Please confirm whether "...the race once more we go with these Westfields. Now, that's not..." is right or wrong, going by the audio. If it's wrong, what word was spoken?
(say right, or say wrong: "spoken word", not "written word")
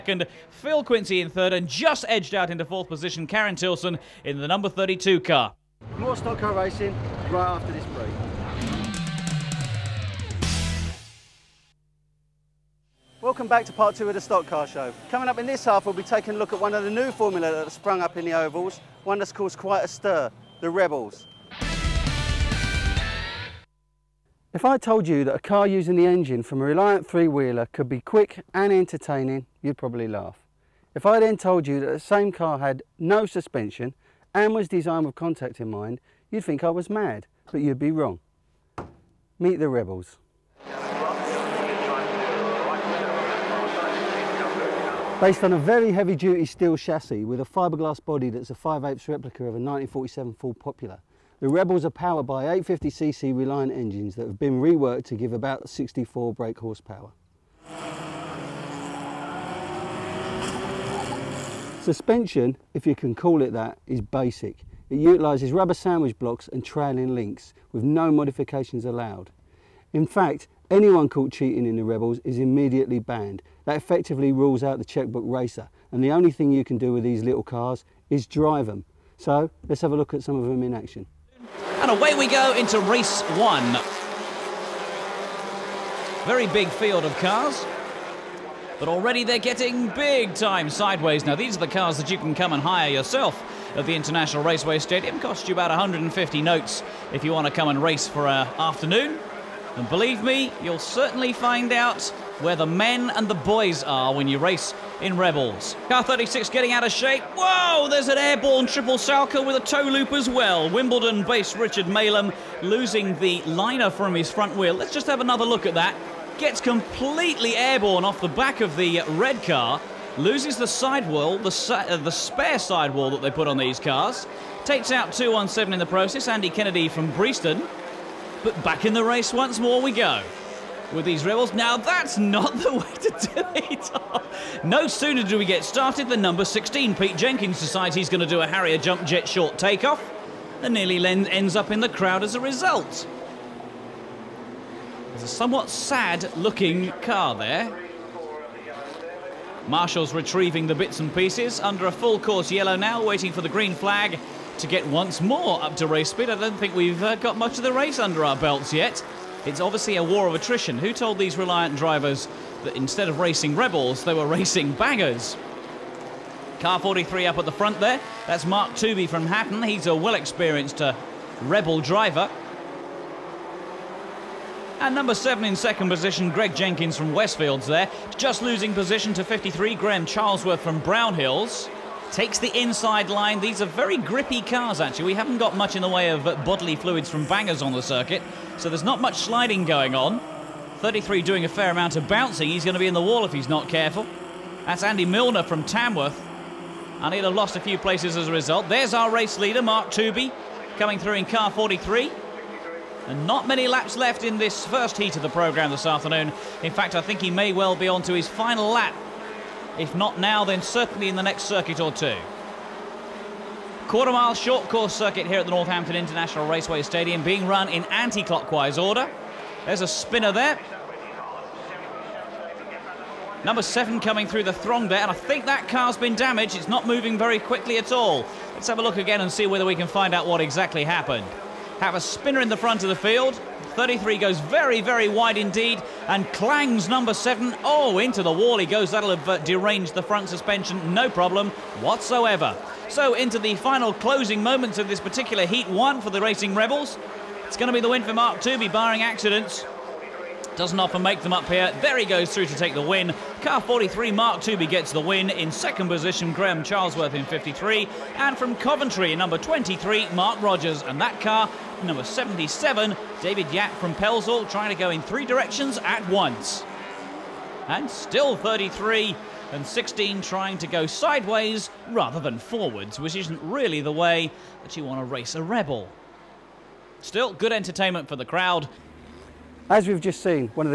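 wrong: "Rebels", not "Westfields".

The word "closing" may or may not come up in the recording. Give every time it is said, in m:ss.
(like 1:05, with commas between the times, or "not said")
4:03.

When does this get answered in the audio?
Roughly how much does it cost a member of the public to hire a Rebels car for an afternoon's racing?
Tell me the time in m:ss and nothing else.
1:35.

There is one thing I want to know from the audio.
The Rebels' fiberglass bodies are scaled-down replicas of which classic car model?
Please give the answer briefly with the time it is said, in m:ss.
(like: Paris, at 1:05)
1947 Ford Popular, at 0:49.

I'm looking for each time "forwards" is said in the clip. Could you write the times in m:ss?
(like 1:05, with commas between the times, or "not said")
4:32.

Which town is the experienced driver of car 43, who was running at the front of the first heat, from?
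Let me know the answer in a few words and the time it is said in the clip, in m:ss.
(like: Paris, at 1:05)
Hatton, at 2:49.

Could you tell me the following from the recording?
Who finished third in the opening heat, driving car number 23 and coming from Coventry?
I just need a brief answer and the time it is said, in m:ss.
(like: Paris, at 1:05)
Mark Rogers, at 4:20.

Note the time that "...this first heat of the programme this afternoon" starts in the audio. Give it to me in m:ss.
3:24.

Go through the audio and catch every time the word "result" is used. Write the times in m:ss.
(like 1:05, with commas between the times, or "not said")
2:22, 3:18.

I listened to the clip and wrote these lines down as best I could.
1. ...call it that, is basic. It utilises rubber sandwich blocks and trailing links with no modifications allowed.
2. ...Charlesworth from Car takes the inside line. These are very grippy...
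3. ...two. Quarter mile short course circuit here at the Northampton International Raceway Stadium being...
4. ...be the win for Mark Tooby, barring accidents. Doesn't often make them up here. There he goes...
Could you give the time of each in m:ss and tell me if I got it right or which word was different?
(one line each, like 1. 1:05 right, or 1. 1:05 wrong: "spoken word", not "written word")
1. 1:03 right
2. 3:00 wrong: "Brownhills", not "Car"
3. 3:31 right
4. 4:07 right.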